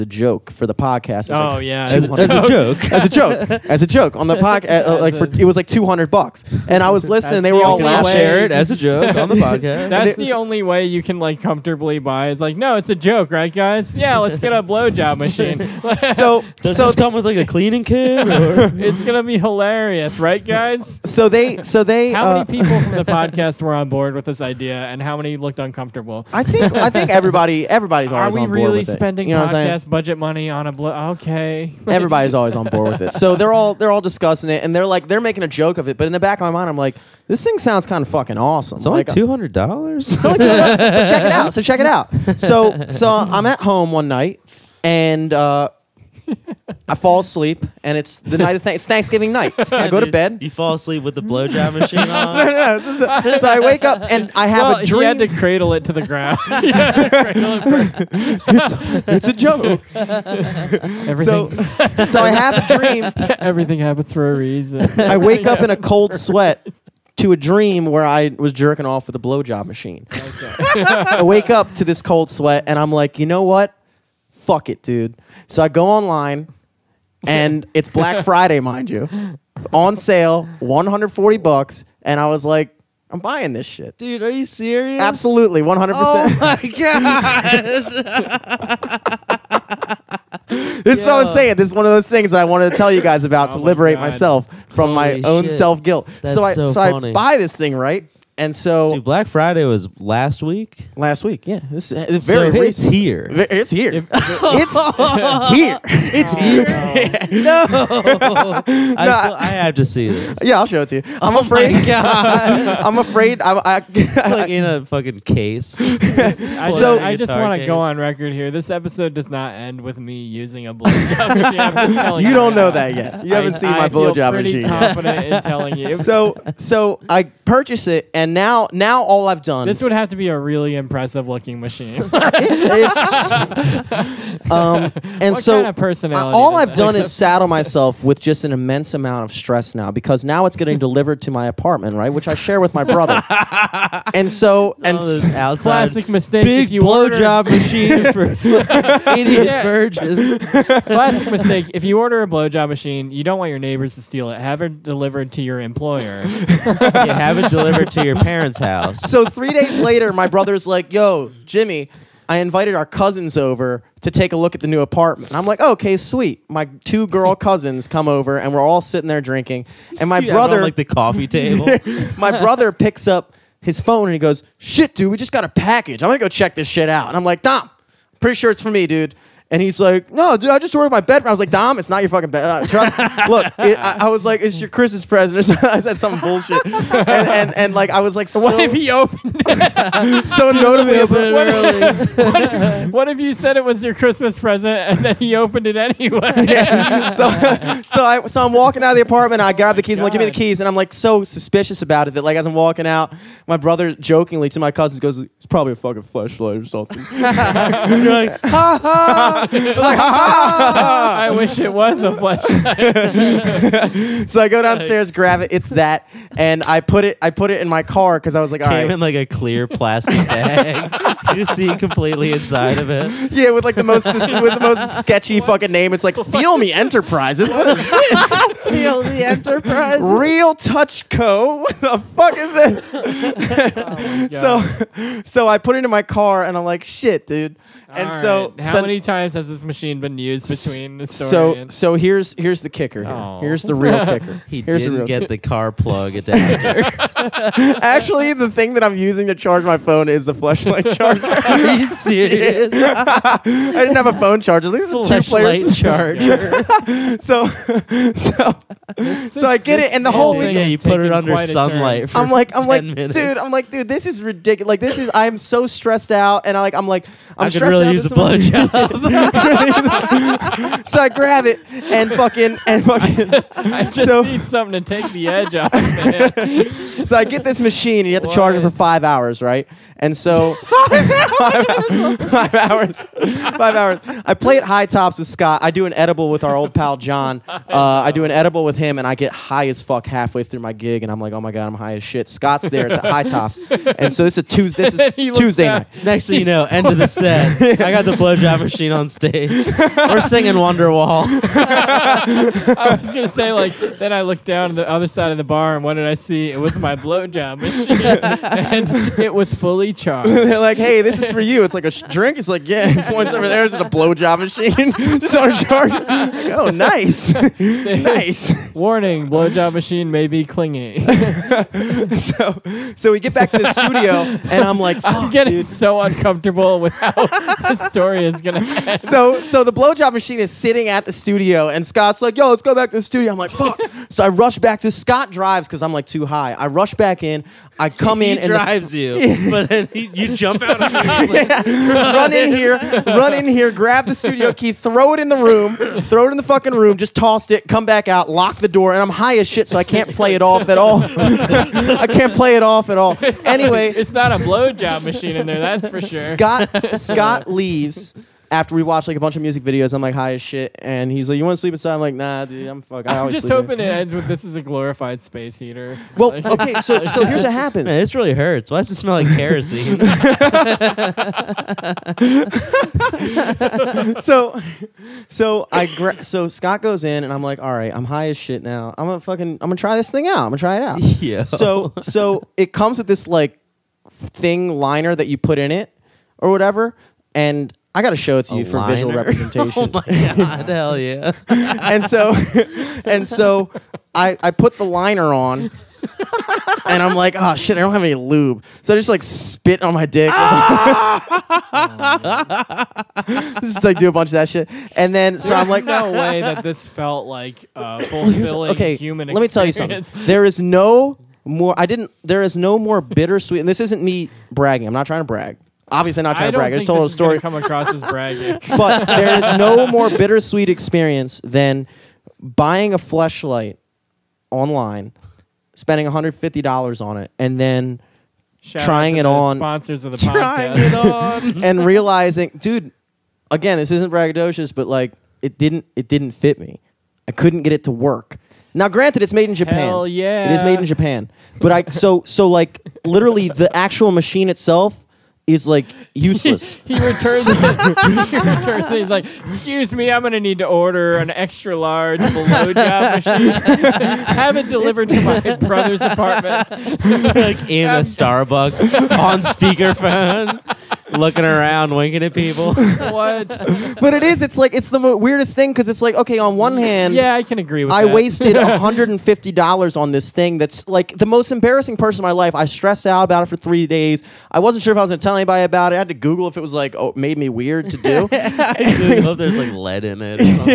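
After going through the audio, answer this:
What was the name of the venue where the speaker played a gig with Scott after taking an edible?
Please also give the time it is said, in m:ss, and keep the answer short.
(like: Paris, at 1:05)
High Tops, at 4:44.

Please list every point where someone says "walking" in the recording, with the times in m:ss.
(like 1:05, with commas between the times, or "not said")
3:18, 3:22.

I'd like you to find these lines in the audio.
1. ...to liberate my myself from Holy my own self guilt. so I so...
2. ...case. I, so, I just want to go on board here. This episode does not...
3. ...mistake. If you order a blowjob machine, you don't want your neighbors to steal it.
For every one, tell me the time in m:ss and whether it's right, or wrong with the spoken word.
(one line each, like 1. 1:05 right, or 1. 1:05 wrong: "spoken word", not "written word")
1. 1:33 right
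2. 1:55 wrong: "record", not "board"
3. 2:31 right.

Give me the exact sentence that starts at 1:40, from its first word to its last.
last week, yeah, this uh, it's very so it's here.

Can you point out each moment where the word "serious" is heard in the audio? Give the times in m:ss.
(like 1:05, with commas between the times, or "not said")
1:24, 4:11.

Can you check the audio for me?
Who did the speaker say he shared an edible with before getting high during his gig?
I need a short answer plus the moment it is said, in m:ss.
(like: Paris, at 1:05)
John, at 4:46.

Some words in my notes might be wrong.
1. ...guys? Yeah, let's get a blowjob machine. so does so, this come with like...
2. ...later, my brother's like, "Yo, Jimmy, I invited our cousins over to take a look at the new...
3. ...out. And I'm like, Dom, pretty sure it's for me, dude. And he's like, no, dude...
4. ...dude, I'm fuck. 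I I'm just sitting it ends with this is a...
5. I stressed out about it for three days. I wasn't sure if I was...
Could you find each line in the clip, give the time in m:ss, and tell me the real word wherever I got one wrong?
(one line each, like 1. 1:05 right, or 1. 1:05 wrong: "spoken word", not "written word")
1. 0:13 right
2. 2:39 right
3. 2:56 right
4. 6:02 wrong: "hoping", not "sitting"
5. 7:52 right.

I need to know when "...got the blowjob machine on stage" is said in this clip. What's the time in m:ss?
4:57.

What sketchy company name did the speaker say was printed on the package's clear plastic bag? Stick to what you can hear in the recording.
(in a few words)
Feel Me Enterprises.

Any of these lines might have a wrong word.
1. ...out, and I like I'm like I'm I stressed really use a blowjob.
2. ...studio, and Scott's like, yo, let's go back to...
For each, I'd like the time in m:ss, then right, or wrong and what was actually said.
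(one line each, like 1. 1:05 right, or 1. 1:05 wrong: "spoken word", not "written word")
1. 4:26 right
2. 5:31 right.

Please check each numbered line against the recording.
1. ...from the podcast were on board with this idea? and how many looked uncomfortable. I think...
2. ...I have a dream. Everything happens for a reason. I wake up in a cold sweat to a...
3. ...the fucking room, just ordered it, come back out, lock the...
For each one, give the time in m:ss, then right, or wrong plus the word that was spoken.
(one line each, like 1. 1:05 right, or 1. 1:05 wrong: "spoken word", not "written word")
1. 0:22 right
2. 1:02 right
3. 5:46 wrong: "tossed", not "ordered".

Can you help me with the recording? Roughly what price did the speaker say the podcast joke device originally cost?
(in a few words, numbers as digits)
200 bucks.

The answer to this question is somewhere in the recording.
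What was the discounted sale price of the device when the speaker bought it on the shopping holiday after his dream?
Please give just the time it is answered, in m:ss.
1:20.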